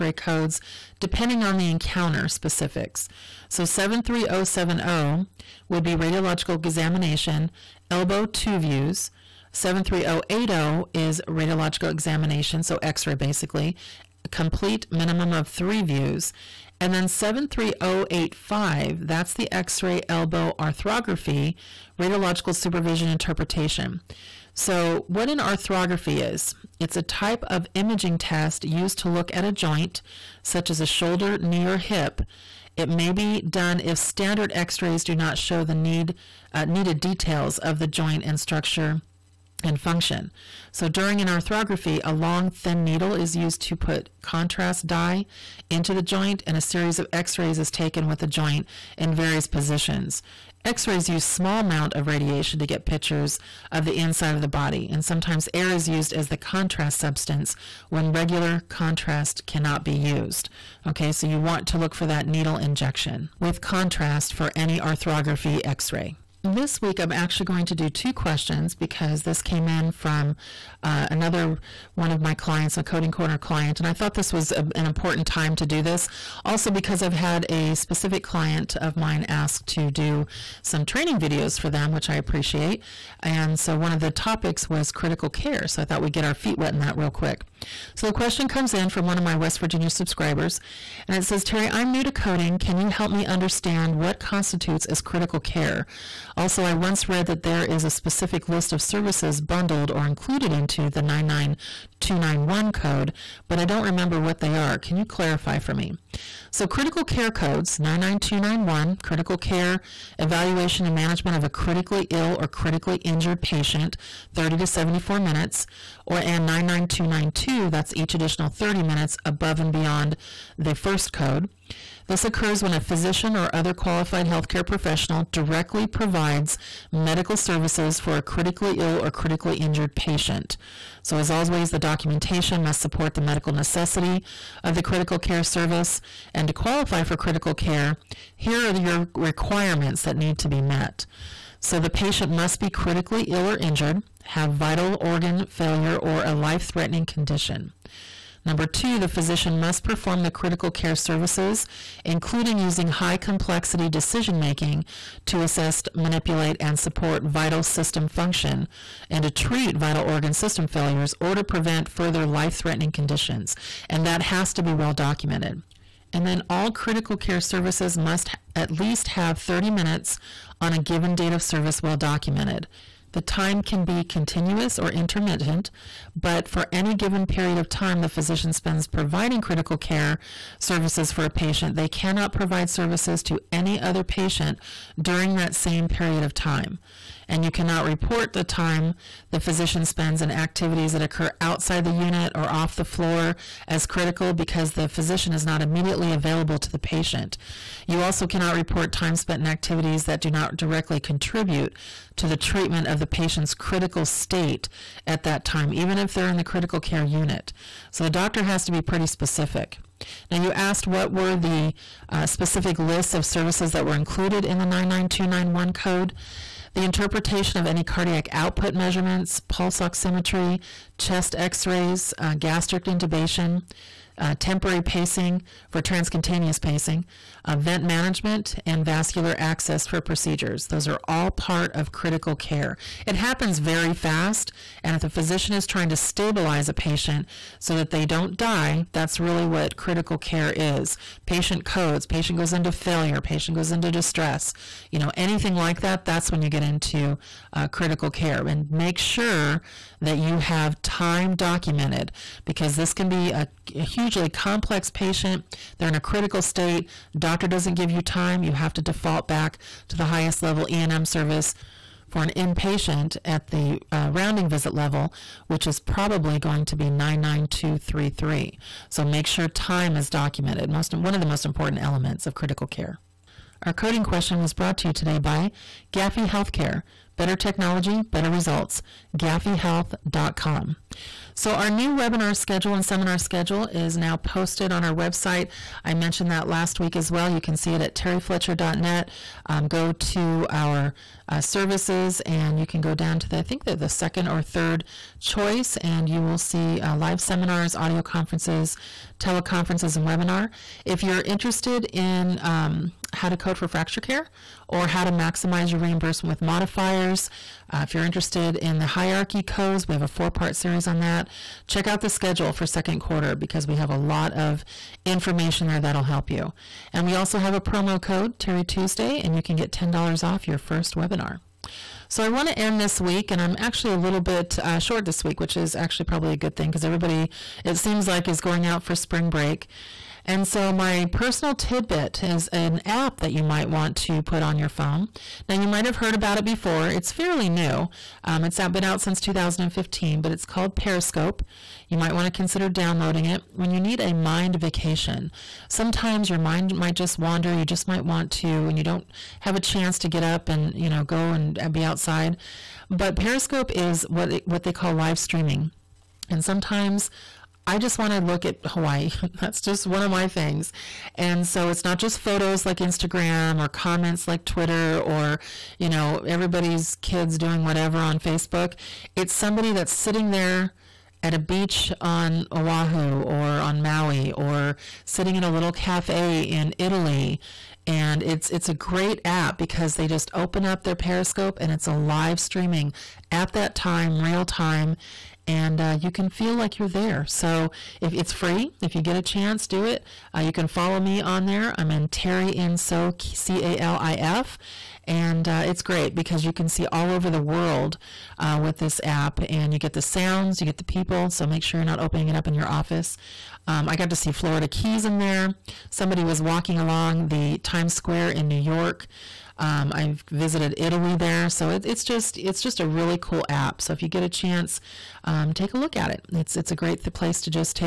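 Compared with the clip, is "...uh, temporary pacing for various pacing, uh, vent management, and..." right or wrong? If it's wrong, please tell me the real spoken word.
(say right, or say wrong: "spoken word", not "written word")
wrong: "transcutaneous", not "various".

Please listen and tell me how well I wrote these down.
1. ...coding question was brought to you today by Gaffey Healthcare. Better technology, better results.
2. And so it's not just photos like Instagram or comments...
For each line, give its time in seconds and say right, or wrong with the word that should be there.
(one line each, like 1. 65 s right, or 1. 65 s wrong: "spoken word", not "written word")
1. 273 s right
2. 361 s right.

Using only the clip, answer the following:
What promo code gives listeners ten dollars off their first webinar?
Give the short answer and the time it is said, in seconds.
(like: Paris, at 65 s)
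Terry Tuesday, at 318 s.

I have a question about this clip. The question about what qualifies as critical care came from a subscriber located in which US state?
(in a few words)
West Virginia.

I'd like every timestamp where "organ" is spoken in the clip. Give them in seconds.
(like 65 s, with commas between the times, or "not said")
144 s, 160 s.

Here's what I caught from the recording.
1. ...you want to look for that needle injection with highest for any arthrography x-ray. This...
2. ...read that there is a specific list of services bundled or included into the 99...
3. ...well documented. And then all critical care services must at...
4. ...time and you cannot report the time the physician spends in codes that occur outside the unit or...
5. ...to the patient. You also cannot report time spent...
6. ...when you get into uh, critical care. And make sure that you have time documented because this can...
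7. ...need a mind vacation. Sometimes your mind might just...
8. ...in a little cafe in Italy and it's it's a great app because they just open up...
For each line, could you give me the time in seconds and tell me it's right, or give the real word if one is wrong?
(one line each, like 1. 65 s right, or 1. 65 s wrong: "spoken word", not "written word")
1. 61 s wrong: "contrast", not "highest"
2. 97 s right
3. 164 s right
4. 186 s wrong: "activities", not "codes"
5. 196 s right
6. 246 s right
7. 343 s right
8. 375 s right.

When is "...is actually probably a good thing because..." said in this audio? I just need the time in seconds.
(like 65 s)
325 s.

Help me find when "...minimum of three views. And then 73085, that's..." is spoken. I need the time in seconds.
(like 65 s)
14 s.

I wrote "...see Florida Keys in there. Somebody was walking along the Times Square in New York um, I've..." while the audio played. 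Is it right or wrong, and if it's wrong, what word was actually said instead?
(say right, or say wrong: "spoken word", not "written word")
right.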